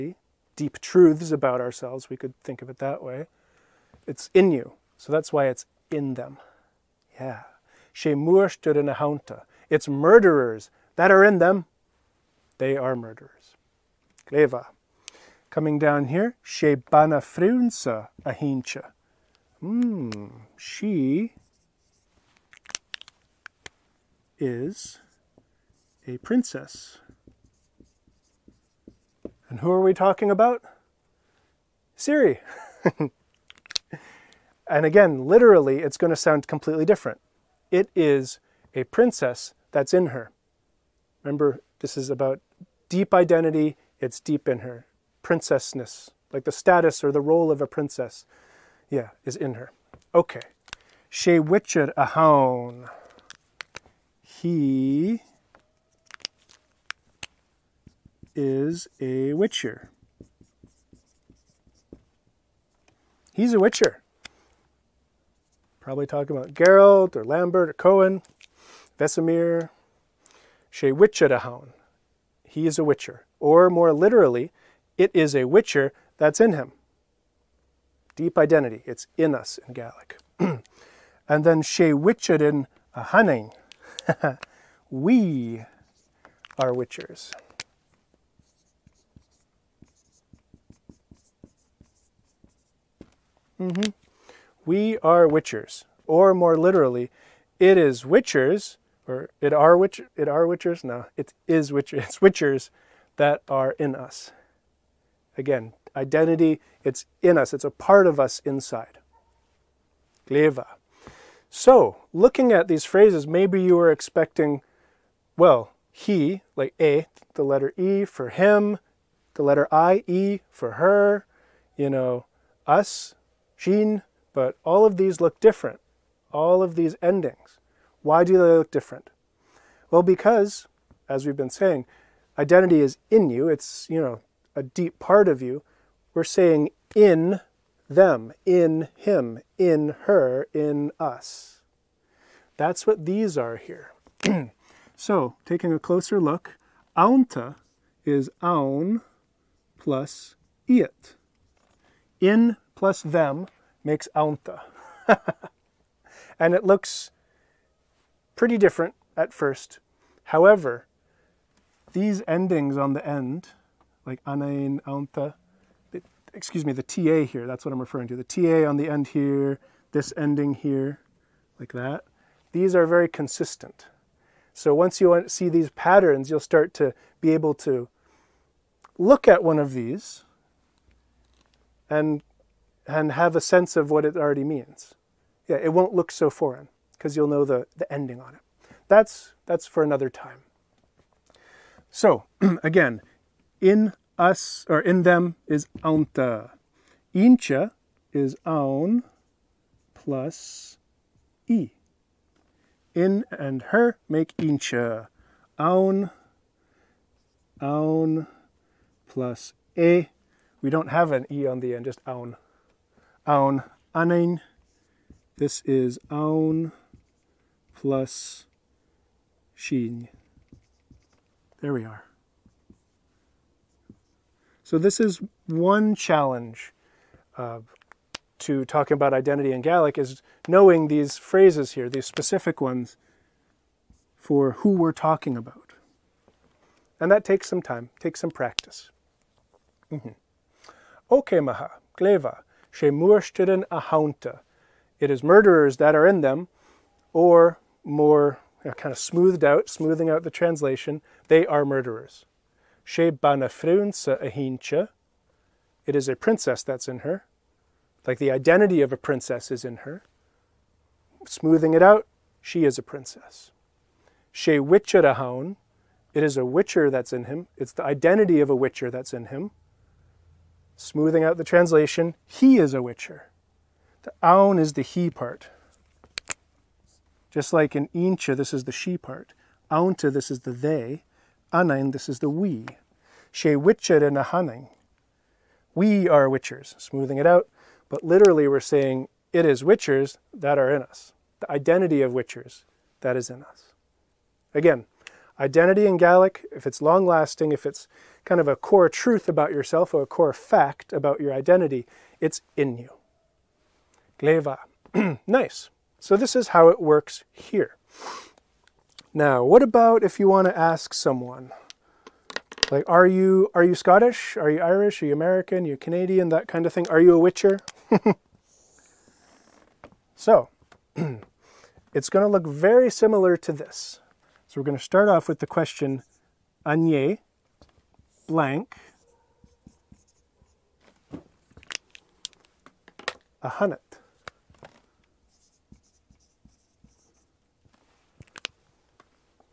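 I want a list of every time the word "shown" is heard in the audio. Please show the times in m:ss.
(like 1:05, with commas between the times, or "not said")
not said.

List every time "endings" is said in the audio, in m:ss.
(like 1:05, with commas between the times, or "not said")
2:07, 2:42, 2:50, 3:07.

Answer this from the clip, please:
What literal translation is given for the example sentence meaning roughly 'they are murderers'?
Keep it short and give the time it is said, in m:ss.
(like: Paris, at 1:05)
It's murderers that are in them, at 0:09.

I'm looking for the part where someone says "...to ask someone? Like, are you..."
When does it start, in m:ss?
5:10.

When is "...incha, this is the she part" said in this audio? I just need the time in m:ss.
4:37.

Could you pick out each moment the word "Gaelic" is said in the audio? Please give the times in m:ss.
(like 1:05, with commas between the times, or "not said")
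1:19, 3:49, 4:55.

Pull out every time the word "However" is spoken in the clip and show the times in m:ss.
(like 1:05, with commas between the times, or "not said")
2:40.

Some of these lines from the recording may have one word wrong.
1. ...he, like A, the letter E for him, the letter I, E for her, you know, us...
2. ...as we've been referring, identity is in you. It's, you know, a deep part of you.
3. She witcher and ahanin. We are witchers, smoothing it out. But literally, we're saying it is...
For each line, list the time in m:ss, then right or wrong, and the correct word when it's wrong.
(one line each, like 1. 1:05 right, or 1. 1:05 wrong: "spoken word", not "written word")
1. 1:55 right
2. 2:11 wrong: "saying", not "referring"
3. 4:43 right.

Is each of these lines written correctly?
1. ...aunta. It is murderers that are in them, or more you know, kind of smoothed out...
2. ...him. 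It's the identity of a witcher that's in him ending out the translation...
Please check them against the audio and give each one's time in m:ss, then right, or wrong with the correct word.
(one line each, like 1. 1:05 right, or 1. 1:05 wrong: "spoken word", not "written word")
1. 4:03 wrong: "ahaunta", not "aunta"
2. 4:27 wrong: "smoothing", not "ending".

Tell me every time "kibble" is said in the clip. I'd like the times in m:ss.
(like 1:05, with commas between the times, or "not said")
not said.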